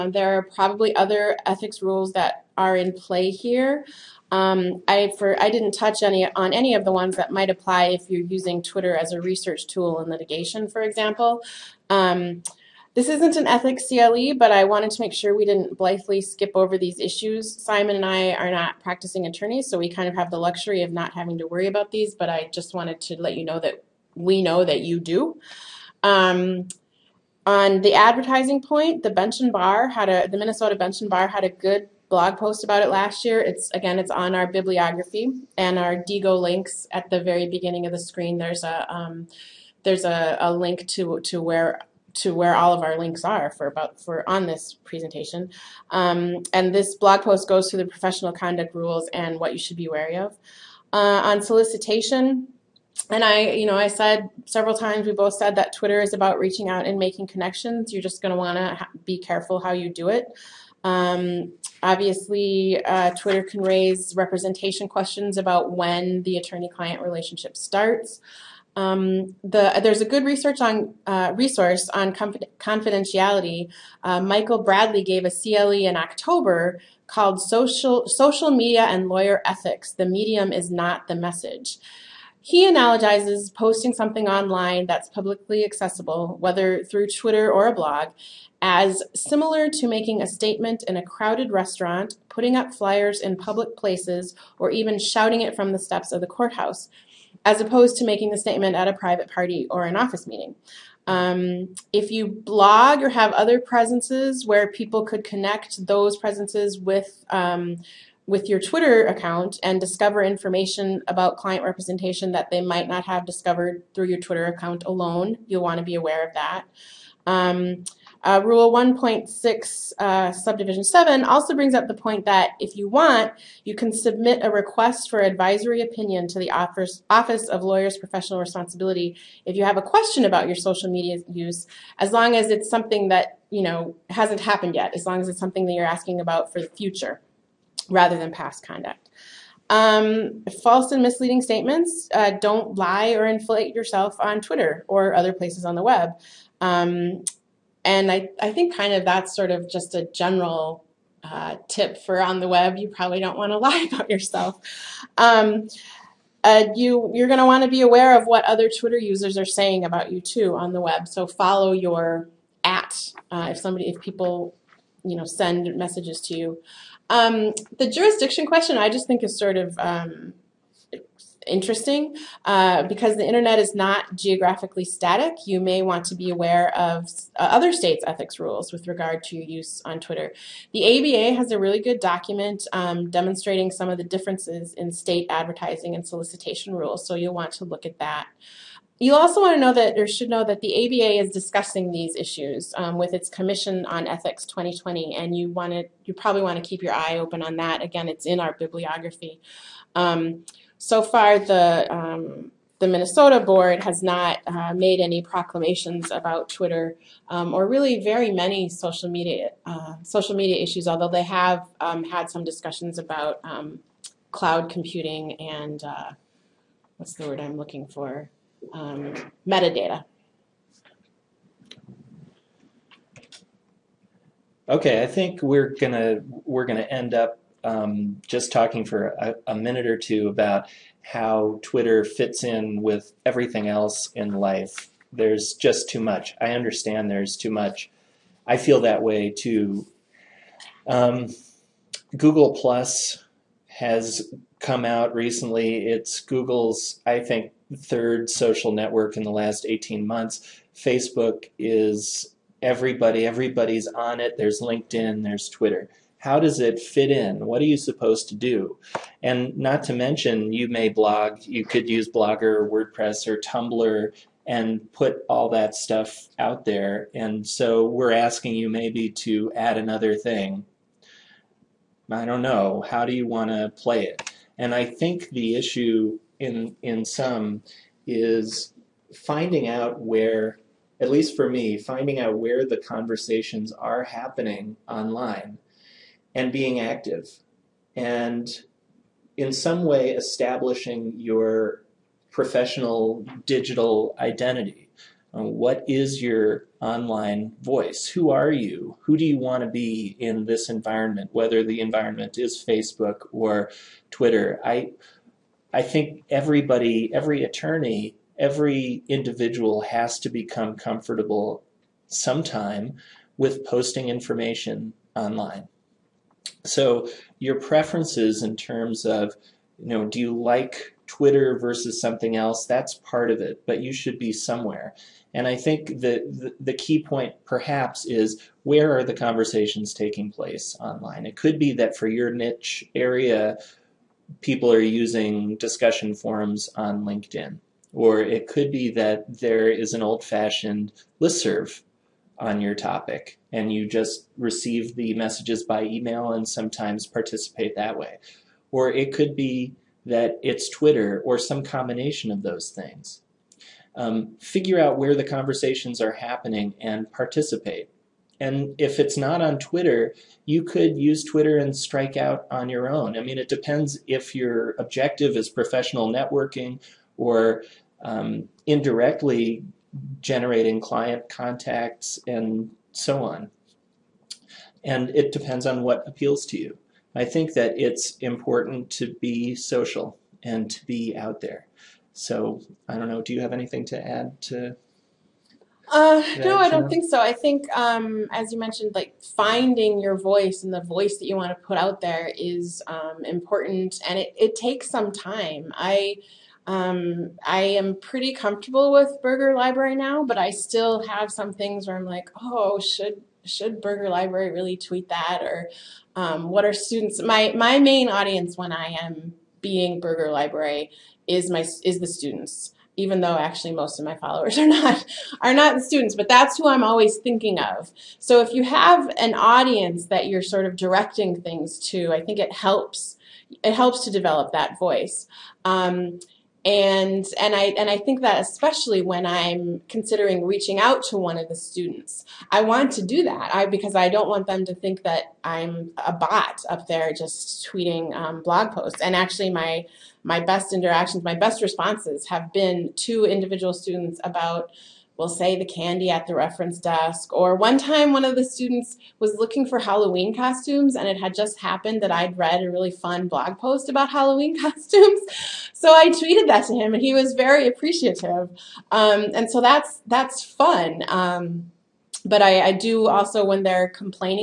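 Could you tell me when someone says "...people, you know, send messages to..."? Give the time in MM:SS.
02:43.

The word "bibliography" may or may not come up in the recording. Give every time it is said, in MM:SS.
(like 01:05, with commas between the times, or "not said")
00:34, 03:18.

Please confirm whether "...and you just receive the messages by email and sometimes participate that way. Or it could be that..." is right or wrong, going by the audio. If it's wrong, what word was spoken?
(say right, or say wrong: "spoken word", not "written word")
right.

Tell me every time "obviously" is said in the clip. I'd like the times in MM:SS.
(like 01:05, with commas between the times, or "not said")
01:01.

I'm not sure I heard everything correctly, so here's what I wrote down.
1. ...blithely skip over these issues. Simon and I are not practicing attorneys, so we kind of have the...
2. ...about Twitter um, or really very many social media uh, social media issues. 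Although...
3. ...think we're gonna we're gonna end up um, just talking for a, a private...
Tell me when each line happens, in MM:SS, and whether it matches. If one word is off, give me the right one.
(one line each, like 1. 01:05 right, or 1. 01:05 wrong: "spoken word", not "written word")
1. 00:15 right
2. 03:26 right
3. 03:45 wrong: "minute", not "private".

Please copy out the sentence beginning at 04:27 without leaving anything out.
And so we're asking you maybe to add another thing.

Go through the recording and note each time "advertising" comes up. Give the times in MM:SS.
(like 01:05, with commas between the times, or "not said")
00:27, 03:05.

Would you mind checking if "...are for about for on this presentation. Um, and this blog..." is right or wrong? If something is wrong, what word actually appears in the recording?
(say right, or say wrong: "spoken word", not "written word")
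right.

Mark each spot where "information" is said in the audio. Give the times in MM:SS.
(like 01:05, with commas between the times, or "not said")
01:50, 05:14.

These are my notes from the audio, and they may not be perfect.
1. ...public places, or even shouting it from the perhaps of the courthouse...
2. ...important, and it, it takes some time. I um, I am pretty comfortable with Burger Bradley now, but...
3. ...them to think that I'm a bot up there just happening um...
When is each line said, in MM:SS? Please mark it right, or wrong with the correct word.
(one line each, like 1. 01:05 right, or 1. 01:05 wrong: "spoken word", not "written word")
1. 01:33 wrong: "steps", not "perhaps"
2. 06:33 wrong: "Library", not "Bradley"
3. 07:14 wrong: "tweeting", not "happening".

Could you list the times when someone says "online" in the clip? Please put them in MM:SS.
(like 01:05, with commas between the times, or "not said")
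01:24, 04:44, 04:56, 05:15, 05:30.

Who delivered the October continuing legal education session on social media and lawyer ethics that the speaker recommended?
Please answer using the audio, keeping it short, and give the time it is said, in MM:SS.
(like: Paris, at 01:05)
Michael Bradley, at 01:14.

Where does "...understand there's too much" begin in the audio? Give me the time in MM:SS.
03:56.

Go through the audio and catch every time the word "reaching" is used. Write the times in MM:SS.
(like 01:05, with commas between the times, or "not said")
00:56, 07:10.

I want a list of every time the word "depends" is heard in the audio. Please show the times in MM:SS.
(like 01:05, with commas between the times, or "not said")
06:03, 06:15.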